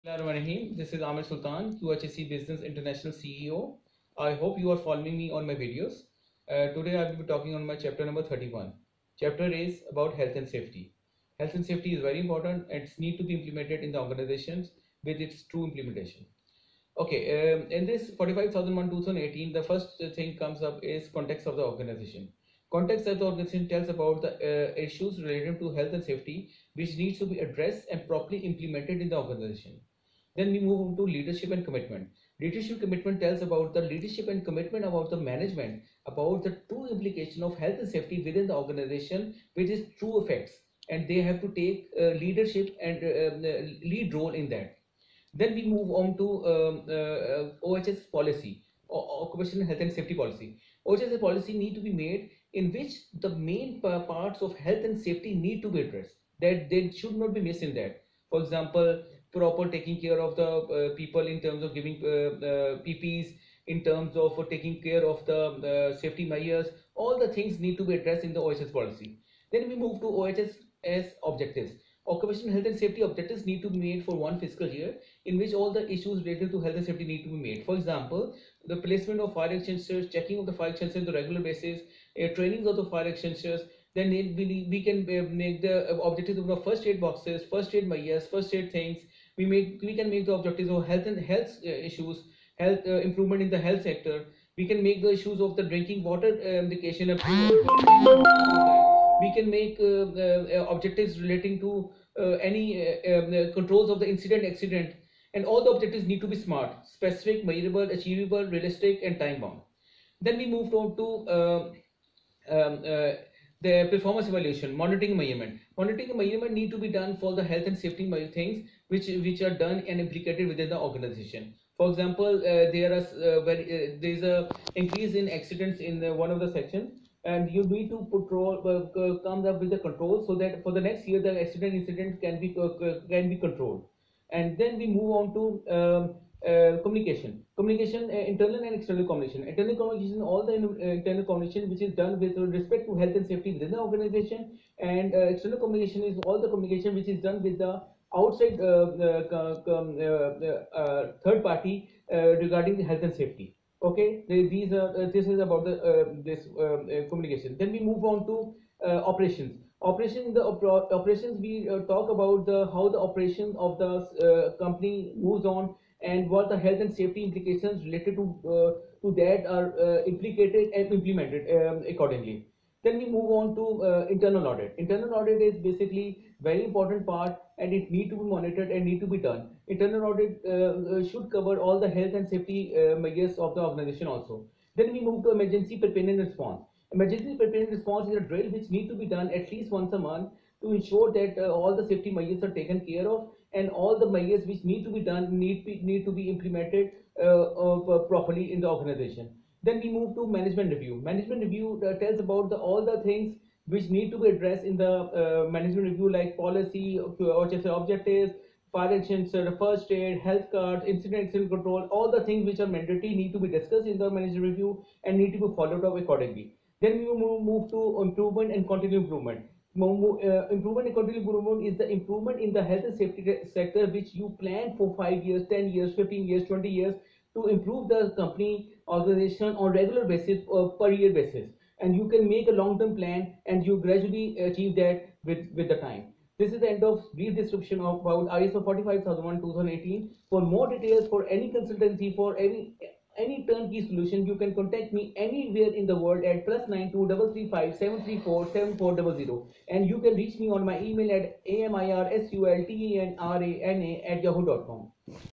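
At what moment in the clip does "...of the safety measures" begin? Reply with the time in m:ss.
1:05.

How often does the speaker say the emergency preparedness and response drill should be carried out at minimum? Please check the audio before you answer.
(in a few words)
Once a month.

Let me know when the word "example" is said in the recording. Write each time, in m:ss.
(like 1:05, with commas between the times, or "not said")
0:58, 1:17, 2:01.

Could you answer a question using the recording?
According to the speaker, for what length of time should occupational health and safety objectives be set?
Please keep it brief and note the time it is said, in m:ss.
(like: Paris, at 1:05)
One fiscal year, at 1:14.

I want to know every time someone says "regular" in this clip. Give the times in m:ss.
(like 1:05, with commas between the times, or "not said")
1:21, 3:49.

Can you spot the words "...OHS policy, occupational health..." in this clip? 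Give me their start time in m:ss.
0:47.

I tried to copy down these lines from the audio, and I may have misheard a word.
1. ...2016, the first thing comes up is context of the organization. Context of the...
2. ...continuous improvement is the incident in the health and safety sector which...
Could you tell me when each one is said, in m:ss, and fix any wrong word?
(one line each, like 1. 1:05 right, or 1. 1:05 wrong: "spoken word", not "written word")
1. 0:18 wrong: "2018", not "2016"
2. 3:40 wrong: "improvement", not "incident".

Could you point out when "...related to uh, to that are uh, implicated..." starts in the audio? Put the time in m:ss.
2:47.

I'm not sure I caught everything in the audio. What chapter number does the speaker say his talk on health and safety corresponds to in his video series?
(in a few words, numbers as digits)
31.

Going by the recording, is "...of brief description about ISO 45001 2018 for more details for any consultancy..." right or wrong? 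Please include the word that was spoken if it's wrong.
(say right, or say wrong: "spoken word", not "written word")
right.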